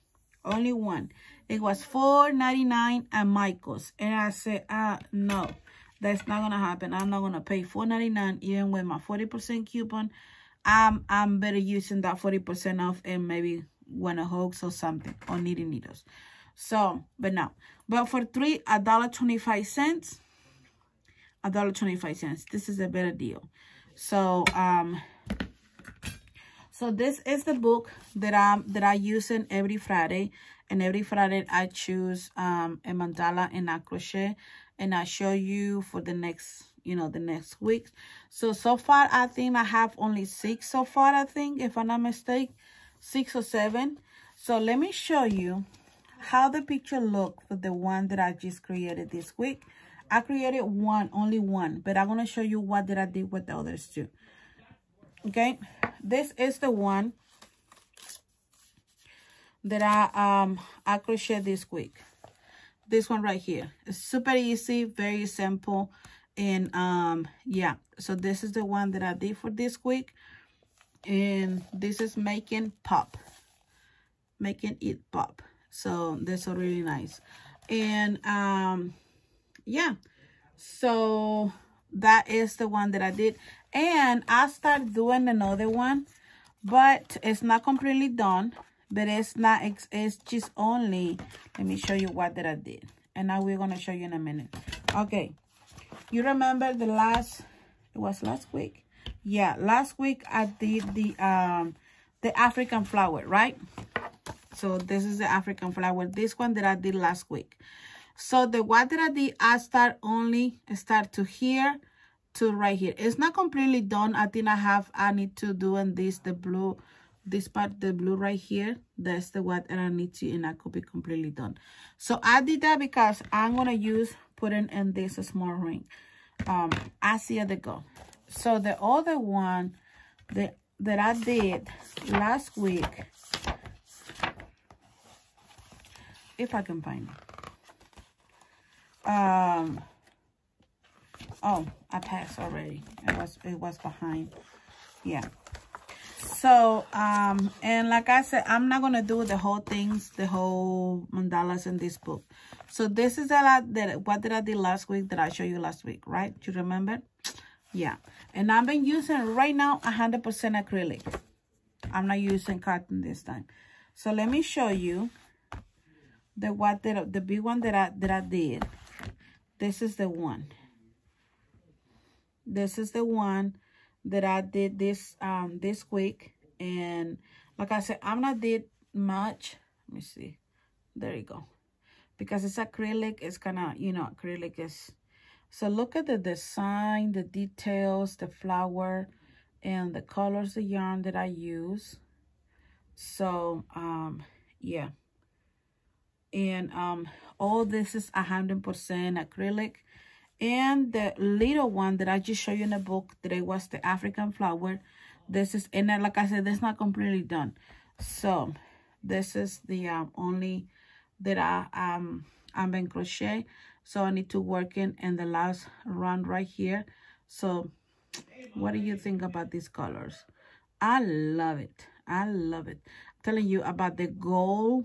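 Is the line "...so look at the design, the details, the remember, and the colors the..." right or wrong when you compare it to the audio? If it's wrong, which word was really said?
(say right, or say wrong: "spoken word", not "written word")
wrong: "flower", not "remember".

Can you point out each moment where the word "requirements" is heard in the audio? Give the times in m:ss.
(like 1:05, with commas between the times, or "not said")
not said.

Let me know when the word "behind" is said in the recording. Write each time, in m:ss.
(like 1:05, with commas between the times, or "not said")
2:23.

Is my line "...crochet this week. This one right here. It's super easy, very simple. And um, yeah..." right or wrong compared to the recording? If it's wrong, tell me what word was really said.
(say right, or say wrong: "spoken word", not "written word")
right.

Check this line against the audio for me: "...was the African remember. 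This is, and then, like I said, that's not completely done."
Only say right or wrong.
wrong.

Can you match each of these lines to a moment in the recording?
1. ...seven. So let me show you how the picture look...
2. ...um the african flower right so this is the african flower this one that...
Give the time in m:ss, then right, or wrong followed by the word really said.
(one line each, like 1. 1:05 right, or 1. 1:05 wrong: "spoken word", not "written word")
1. 0:43 right
2. 1:41 right.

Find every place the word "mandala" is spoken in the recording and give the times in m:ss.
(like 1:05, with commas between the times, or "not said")
0:32, 2:31.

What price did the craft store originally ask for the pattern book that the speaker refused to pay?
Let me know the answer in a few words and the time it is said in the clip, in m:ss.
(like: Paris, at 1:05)
$4.99, at 0:01.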